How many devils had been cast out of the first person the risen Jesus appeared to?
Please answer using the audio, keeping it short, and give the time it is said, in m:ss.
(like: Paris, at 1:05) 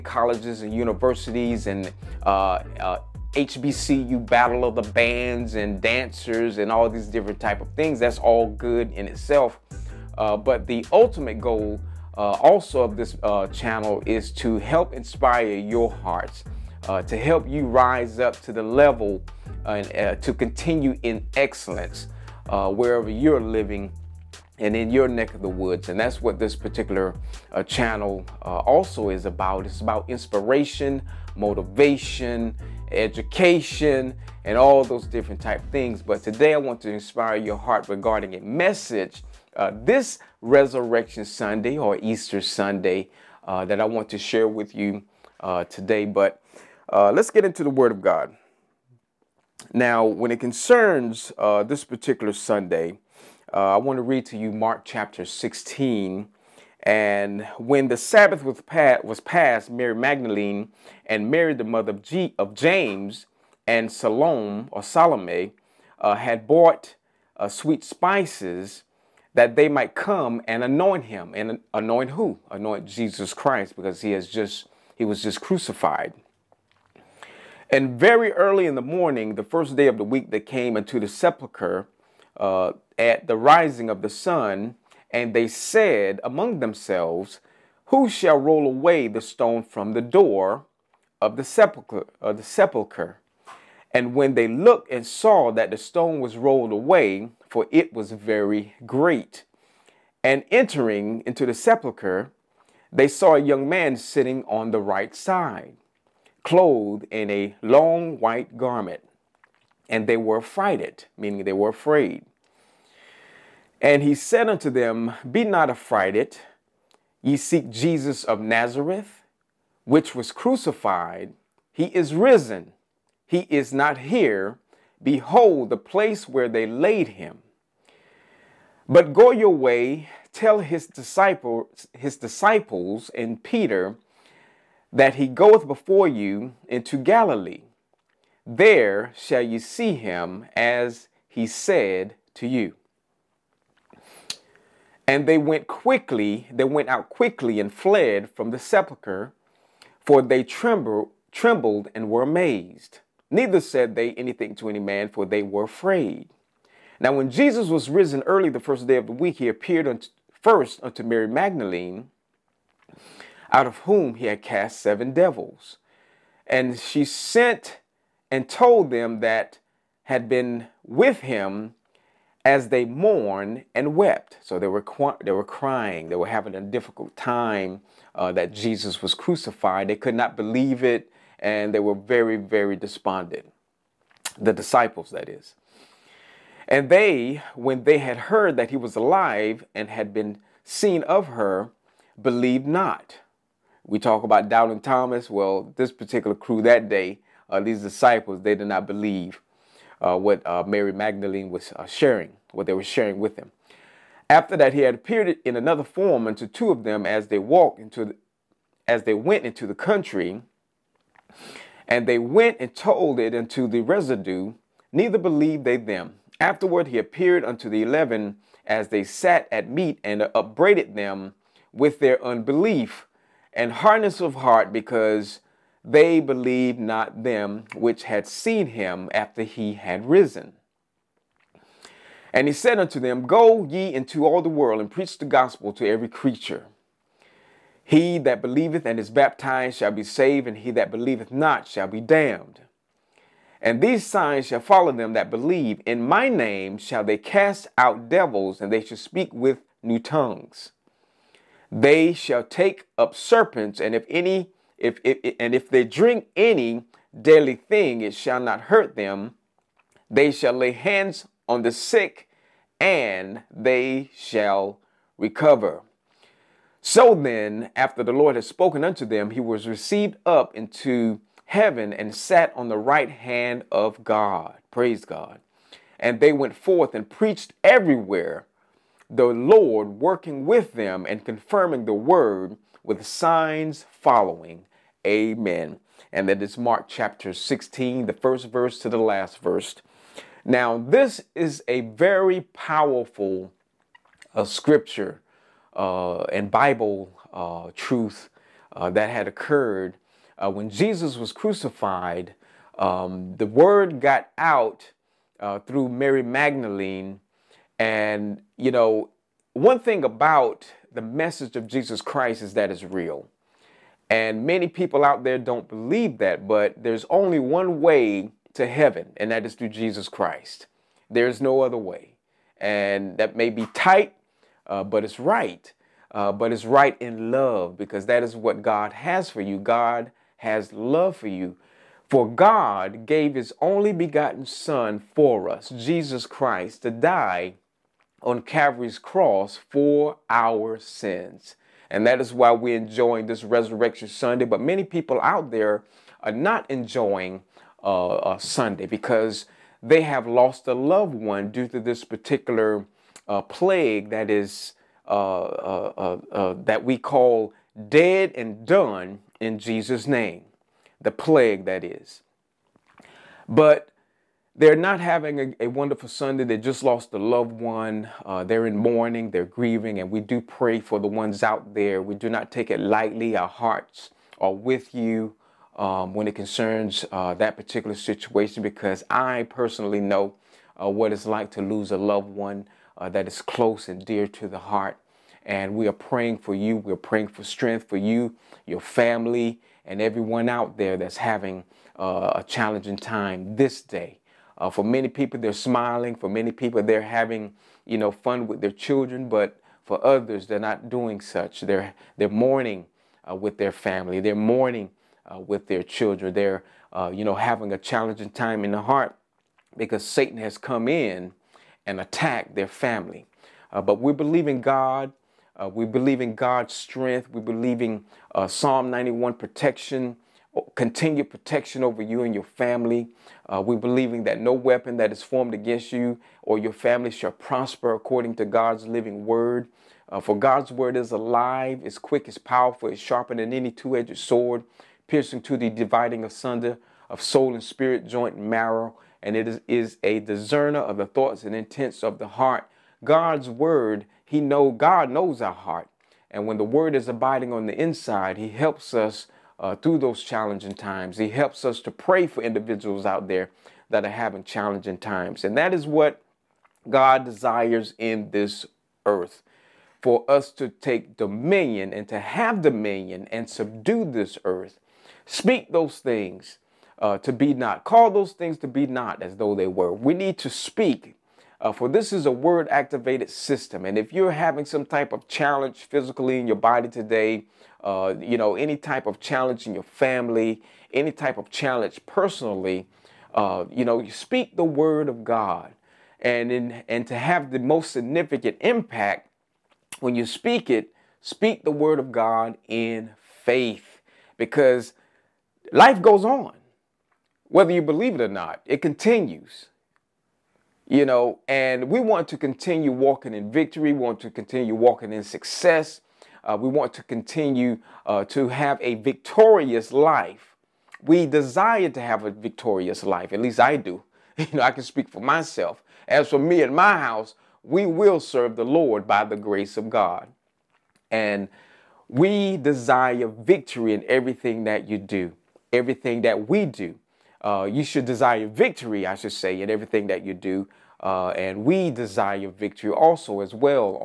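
7, at 2:44.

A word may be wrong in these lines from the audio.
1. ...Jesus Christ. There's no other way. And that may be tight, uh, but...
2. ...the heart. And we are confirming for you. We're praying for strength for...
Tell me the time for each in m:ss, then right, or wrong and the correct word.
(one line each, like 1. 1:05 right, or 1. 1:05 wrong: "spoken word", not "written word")
1. 5:19 right
2. 6:24 wrong: "praying", not "confirming".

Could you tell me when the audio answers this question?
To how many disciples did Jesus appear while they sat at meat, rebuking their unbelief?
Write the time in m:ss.
3:37.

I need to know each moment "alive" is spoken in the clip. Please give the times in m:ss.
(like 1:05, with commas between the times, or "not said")
3:08, 7:11.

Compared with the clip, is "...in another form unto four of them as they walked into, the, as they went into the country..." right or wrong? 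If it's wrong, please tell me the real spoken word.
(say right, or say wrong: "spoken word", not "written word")
wrong: "two", not "four".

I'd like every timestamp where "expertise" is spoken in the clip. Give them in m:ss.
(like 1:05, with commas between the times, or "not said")
not said.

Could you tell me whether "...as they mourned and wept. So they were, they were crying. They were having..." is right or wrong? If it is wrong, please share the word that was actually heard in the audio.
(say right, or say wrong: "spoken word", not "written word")
right.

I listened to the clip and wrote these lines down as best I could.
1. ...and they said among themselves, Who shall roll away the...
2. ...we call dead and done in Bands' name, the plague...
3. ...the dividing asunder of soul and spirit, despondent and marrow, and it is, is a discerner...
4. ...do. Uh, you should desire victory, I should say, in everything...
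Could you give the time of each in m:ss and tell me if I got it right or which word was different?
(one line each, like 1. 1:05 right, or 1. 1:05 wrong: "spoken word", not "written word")
1. 1:25 right
2. 5:56 wrong: "Jesus", not "Bands"
3. 7:15 wrong: "joint", not "despondent"
4. 8:46 right.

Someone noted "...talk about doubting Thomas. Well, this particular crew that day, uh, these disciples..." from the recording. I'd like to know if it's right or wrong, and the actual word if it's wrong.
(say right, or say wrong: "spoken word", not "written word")
right.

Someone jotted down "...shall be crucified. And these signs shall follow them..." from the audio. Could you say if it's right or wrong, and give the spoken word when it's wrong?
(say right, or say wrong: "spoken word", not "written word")
wrong: "damned", not "crucified".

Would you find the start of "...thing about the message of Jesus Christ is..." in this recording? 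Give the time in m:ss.
5:09.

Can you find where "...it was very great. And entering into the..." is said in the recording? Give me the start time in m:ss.
1:37.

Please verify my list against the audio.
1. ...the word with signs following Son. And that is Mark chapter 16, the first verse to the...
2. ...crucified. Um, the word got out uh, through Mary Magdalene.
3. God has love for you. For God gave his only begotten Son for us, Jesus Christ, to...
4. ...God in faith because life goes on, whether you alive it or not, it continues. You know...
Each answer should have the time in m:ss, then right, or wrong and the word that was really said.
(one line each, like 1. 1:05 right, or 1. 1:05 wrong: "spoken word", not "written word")
1. 4:41 wrong: "Amen", not "Son"
2. 5:01 right
3. 5:29 right
4. 8:12 wrong: "believe", not "alive".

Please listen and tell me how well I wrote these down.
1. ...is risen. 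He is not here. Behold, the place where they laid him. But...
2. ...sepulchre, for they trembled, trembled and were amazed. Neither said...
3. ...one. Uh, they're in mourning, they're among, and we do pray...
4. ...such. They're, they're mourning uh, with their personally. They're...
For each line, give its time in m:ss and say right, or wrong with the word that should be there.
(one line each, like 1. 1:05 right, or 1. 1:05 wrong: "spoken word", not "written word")
1. 2:01 right
2. 2:28 right
3. 6:07 wrong: "grieving", not "among"
4. 6:41 wrong: "family", not "personally".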